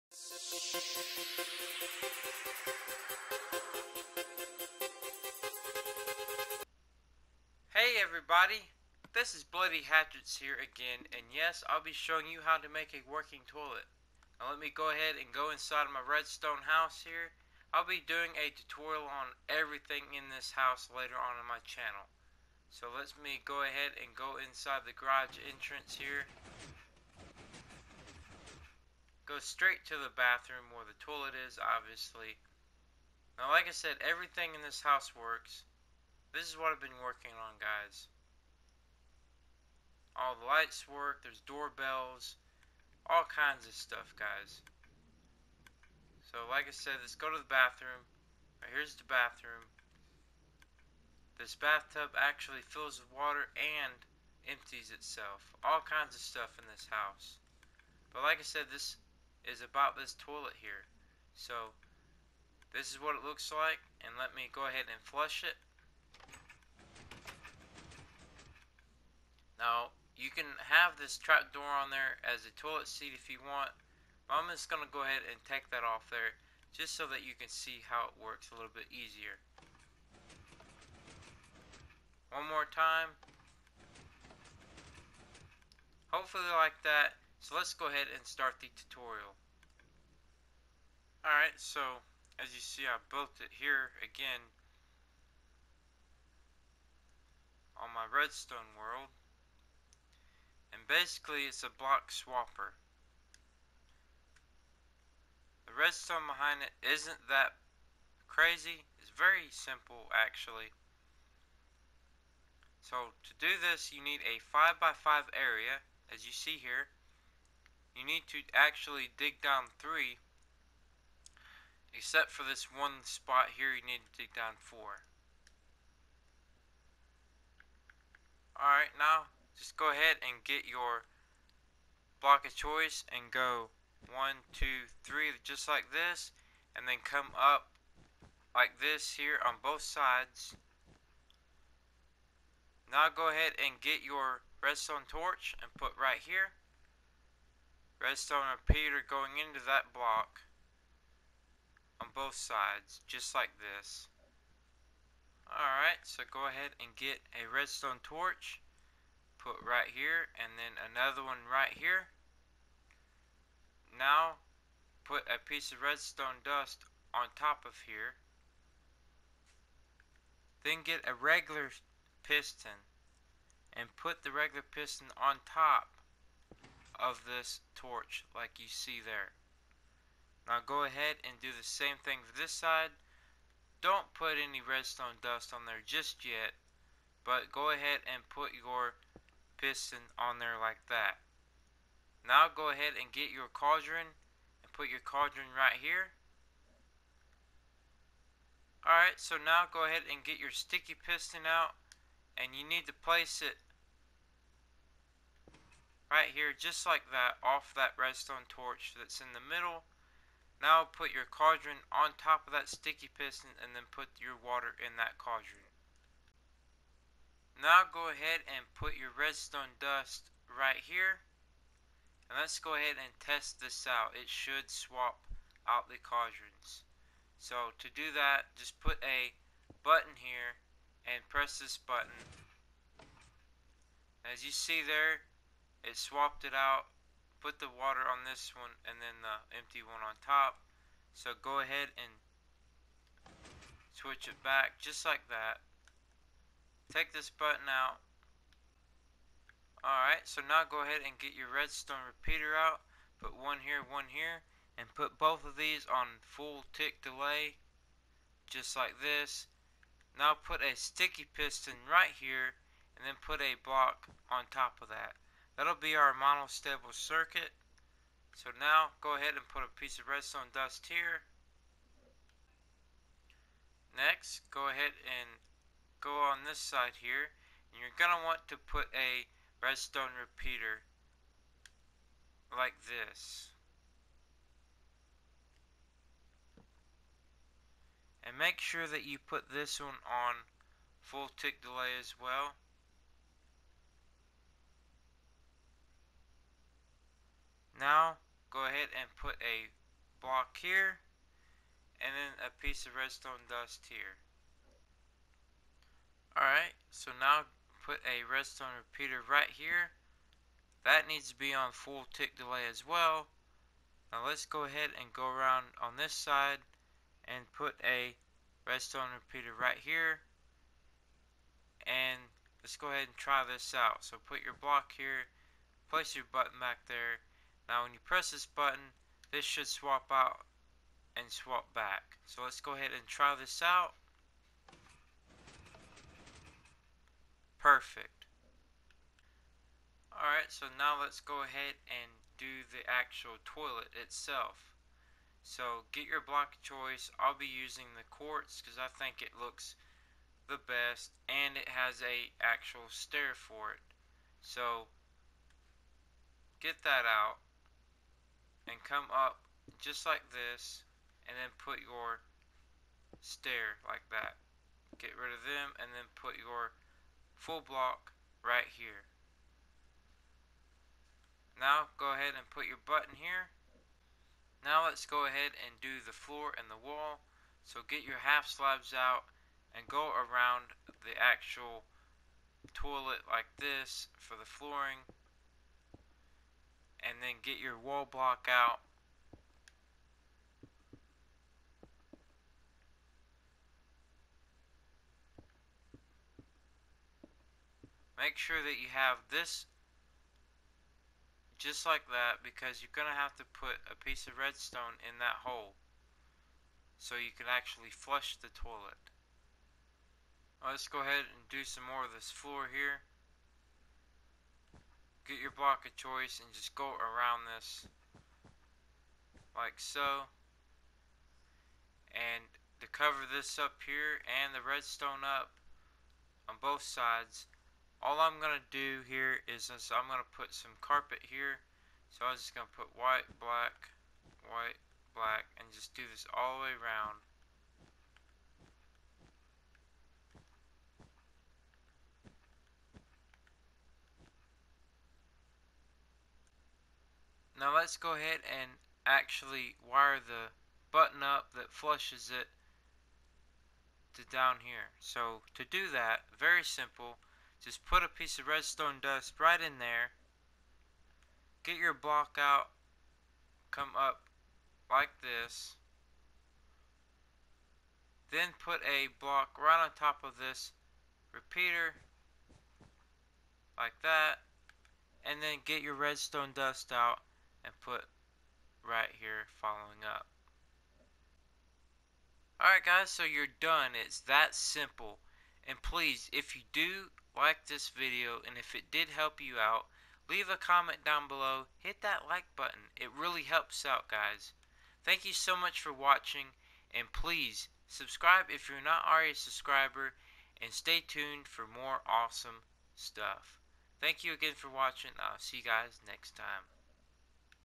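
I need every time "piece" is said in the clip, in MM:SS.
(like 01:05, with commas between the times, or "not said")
02:45, 04:29, 05:02, 06:44, 07:38.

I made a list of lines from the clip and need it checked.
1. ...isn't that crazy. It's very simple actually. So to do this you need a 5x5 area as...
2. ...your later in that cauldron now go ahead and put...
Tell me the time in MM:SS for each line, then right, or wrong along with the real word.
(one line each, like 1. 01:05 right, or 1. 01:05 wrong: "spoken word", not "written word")
1. 01:46 right
2. 03:34 wrong: "water", not "later".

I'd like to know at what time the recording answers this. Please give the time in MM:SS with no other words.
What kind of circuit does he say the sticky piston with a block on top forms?
04:26.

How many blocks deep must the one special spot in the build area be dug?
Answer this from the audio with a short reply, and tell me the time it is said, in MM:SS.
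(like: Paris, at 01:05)
4, at 02:04.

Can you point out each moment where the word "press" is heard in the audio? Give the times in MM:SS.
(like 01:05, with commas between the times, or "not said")
03:51, 05:28.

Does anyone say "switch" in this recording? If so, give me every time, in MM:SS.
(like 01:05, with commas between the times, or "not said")
04:03.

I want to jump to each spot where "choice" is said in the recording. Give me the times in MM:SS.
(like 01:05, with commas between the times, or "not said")
02:12, 05:46, 06:55.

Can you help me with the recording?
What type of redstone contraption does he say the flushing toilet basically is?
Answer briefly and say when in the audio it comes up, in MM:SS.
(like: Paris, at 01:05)
Block swapper, at 01:41.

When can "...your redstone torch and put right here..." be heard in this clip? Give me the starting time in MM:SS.
02:24.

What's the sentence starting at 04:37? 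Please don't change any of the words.
And you're going to want to put a redstone repeater like this.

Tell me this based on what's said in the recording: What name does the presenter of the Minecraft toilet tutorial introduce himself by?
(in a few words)
Bloody Hatchetz.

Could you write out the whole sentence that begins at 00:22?
So let us me go ahead and go inside the garage entrance here.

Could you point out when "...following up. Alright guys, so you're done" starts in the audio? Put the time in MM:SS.
07:59.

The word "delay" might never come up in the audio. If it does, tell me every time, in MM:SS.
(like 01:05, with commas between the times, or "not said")
04:17, 04:51, 05:12.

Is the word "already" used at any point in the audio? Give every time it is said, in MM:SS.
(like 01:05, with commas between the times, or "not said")
08:19.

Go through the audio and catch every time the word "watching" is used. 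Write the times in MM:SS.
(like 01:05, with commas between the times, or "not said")
08:15, 08:24.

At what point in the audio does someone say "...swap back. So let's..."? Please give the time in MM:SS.
05:31.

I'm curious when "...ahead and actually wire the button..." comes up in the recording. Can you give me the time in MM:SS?
07:28.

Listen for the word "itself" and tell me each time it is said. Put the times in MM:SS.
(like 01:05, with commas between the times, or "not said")
00:54, 05:43.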